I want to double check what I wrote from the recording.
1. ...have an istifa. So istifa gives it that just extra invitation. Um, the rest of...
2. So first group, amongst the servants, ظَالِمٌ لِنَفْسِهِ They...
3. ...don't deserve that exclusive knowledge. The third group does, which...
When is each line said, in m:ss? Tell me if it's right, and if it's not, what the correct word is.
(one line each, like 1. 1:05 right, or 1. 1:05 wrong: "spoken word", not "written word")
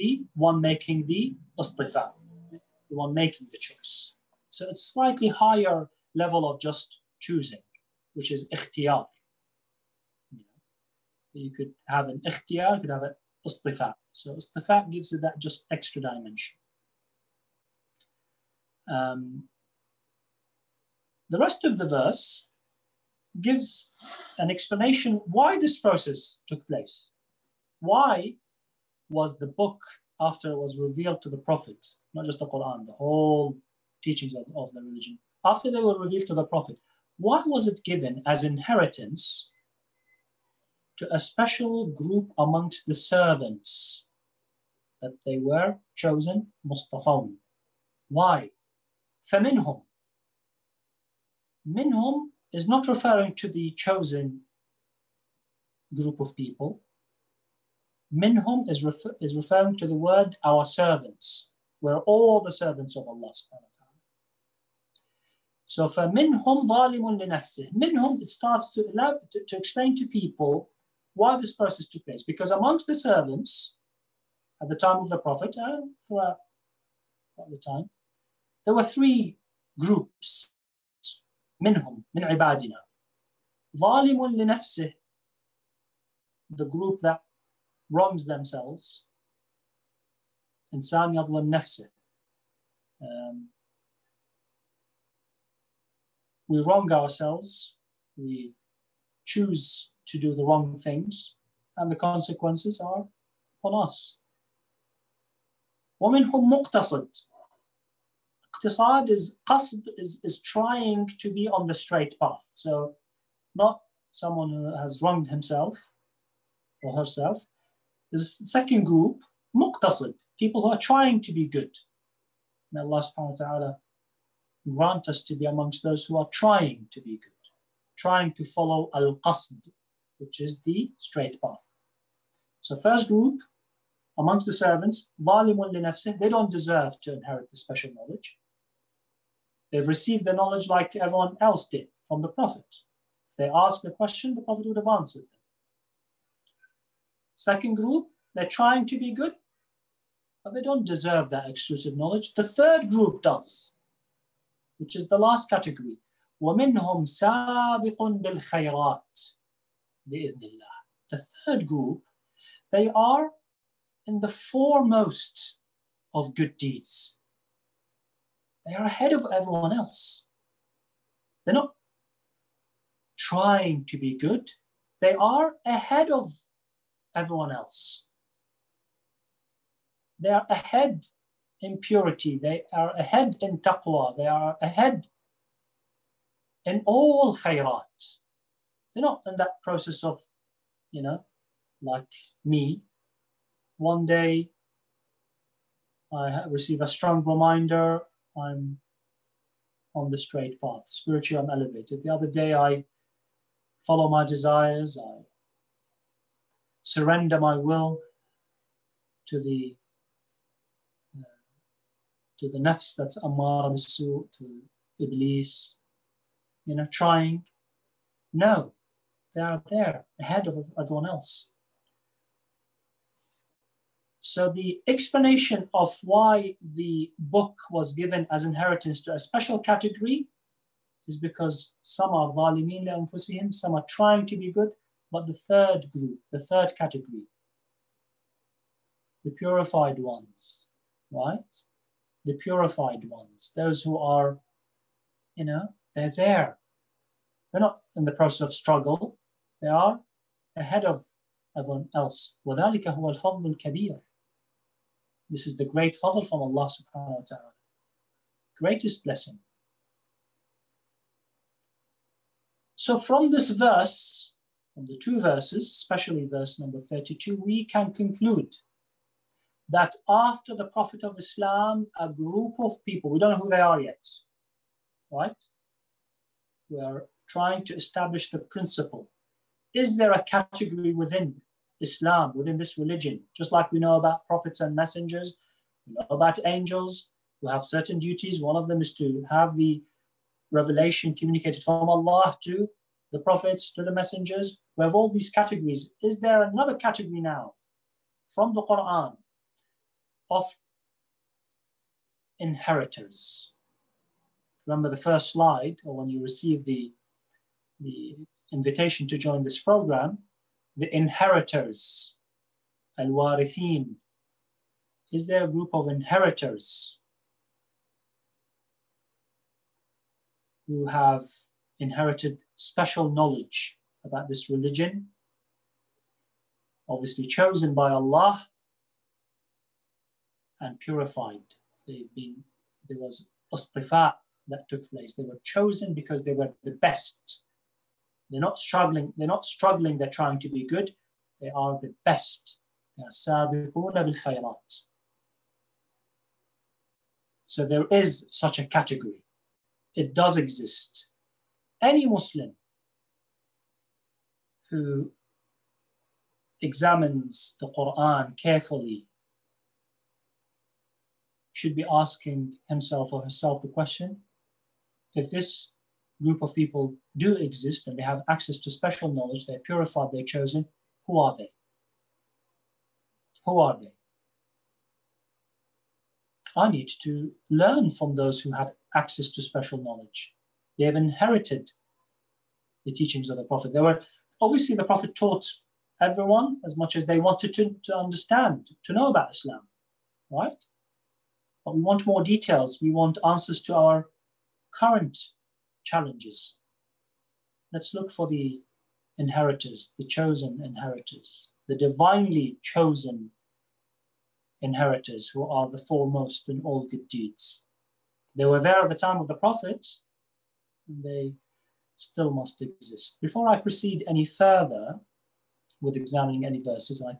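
1. 0:12 wrong: "dimension", not "invitation"
2. 2:12 right
3. 2:30 right.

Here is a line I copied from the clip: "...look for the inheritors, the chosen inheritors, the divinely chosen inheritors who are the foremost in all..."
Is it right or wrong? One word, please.
right.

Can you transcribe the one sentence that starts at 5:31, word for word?
They've been, there was ostrifat that took place.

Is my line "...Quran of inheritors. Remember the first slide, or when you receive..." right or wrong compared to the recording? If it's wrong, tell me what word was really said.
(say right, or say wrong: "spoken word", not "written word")
right.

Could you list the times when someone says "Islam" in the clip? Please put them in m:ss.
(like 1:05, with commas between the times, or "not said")
4:31, 4:41, 6:29.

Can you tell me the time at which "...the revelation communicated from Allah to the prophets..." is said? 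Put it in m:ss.
4:49.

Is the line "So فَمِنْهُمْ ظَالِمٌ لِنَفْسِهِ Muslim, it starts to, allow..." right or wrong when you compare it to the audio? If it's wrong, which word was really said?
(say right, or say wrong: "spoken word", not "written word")
wrong: "Minhum", not "Muslim".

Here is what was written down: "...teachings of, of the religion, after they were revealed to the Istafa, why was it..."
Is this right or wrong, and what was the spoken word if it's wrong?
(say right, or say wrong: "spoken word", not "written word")
wrong: "Prophet", not "Istafa".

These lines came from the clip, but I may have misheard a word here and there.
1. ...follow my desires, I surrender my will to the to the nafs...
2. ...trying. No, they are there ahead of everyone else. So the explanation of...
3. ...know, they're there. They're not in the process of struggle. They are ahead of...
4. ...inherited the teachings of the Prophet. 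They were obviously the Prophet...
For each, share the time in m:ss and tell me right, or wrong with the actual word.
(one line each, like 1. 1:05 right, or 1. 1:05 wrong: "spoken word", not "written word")
1. 3:23 right
2. 3:36 right
3. 4:05 right
4. 6:20 right.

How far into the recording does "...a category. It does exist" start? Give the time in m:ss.
5:48.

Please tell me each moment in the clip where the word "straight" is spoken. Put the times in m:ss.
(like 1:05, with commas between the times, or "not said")
1:51, 2:10, 3:20.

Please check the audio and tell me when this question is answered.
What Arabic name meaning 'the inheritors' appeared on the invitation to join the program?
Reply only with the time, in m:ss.
5:12.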